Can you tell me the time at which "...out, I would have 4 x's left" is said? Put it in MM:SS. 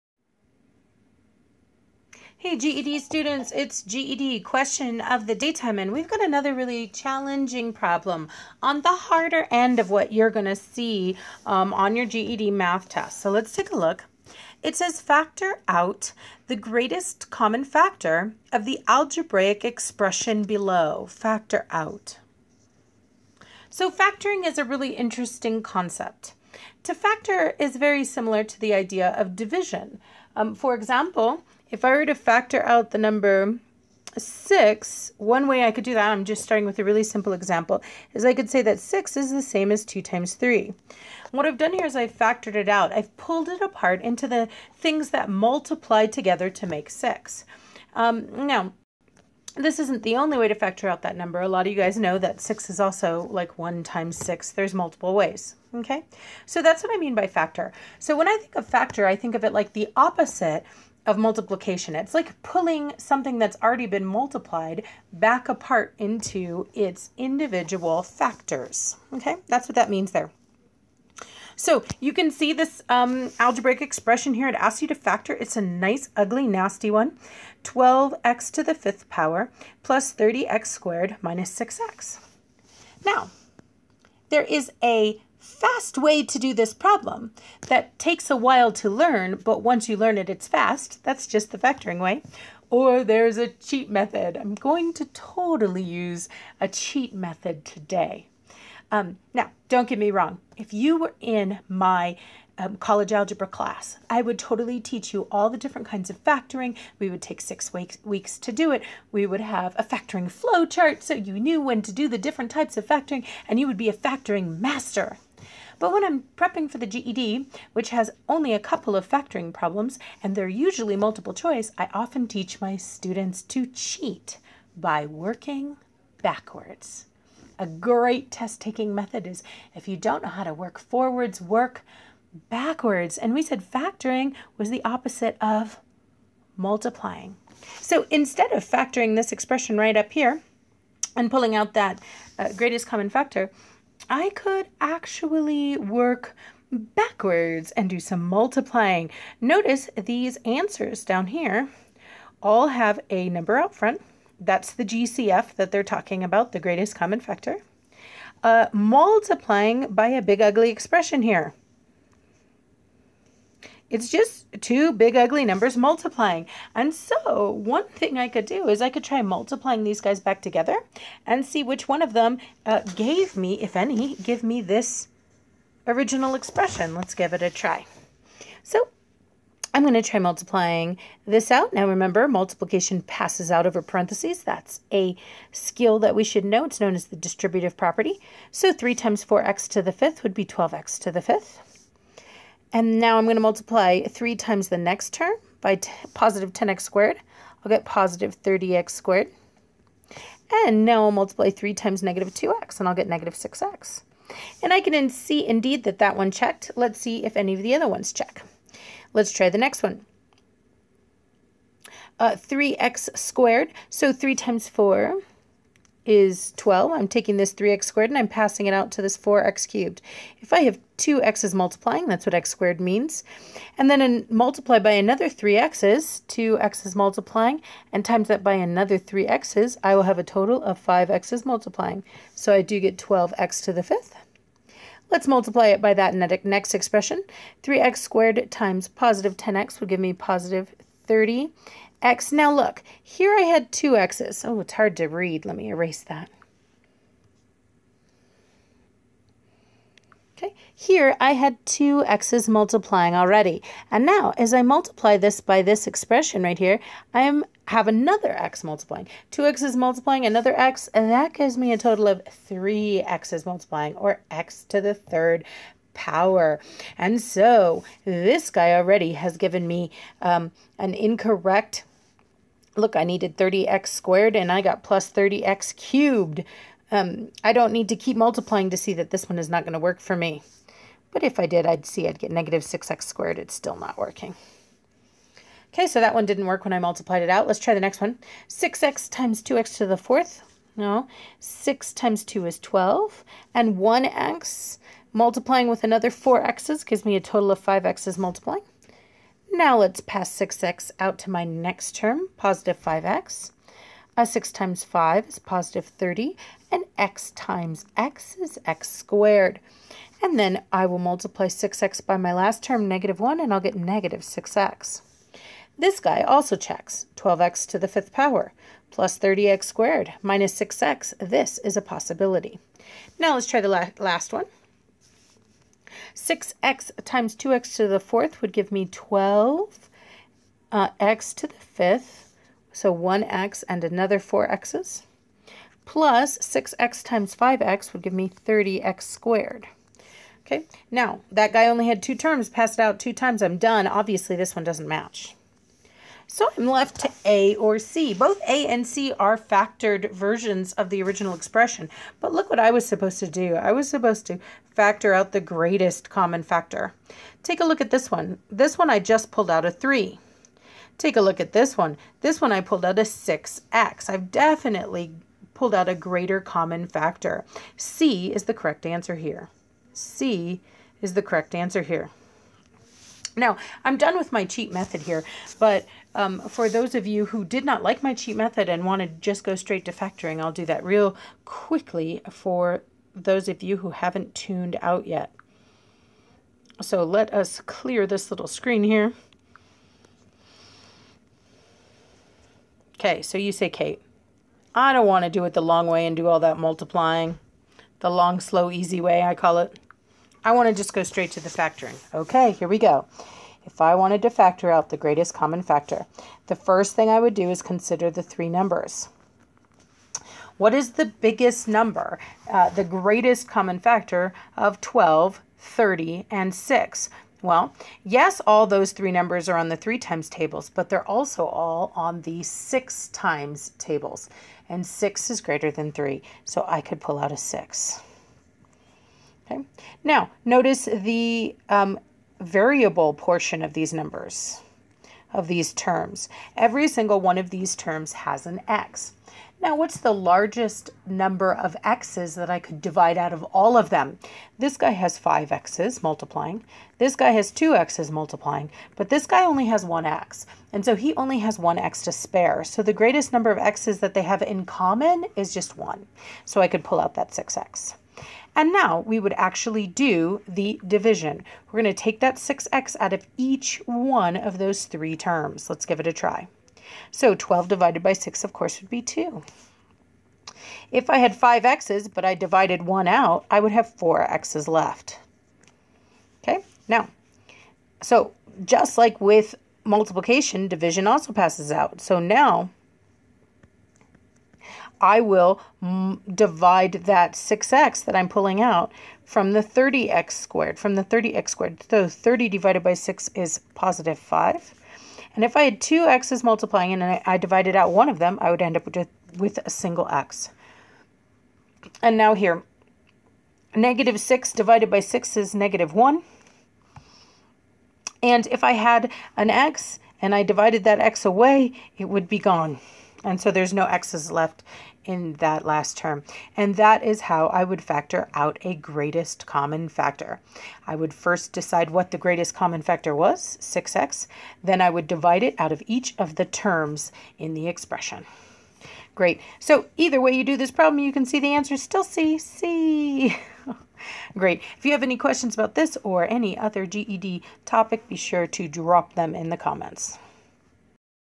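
07:53.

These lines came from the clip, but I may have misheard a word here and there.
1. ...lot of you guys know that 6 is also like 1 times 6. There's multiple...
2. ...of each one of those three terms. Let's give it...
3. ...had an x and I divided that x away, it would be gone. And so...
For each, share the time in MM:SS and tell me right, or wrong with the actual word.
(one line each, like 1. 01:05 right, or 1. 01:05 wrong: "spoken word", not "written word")
1. 00:51 right
2. 07:43 right
3. 08:28 right.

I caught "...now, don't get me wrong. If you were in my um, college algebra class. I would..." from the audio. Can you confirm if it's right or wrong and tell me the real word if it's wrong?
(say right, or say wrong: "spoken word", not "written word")
right.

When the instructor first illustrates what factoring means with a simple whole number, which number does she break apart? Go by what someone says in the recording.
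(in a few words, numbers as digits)
6.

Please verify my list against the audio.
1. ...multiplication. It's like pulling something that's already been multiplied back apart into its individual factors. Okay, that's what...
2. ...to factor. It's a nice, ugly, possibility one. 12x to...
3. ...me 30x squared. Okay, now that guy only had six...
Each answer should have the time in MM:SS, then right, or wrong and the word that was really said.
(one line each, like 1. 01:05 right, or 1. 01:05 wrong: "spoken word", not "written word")
1. 01:01 right
2. 01:14 wrong: "nasty", not "possibility"
3. 05:38 wrong: "two", not "six".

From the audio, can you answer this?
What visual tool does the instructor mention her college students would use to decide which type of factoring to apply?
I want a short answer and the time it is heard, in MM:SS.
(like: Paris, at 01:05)
factoring flow chart, at 01:49.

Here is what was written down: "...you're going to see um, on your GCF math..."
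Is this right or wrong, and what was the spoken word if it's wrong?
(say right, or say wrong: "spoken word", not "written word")
wrong: "GED", not "GCF".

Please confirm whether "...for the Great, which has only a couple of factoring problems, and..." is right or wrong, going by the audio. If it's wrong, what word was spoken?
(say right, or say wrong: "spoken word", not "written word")
wrong: "GED", not "Great".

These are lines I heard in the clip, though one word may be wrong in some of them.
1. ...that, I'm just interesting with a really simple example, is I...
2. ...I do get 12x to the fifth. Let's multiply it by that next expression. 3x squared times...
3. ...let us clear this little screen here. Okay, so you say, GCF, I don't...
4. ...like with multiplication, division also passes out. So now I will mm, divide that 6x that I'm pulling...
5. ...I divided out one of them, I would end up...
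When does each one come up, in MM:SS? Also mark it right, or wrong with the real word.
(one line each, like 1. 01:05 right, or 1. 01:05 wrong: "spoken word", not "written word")
1. 00:35 wrong: "starting", not "interesting"
2. 03:52 right
3. 06:27 wrong: "Kate", not "GCF"
4. 07:58 right
5. 08:17 right.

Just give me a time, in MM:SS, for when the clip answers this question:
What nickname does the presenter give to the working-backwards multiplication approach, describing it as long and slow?
06:37.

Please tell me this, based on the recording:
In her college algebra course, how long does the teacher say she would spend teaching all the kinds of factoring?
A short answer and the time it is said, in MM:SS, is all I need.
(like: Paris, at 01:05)
six weeks, at 01:47.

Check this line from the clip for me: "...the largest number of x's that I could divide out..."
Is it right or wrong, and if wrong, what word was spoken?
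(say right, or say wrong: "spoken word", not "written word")
right.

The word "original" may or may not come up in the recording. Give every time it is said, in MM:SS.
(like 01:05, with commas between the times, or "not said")
02:55, 05:51.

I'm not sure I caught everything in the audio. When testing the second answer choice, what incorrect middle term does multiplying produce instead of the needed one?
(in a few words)
30x cubed.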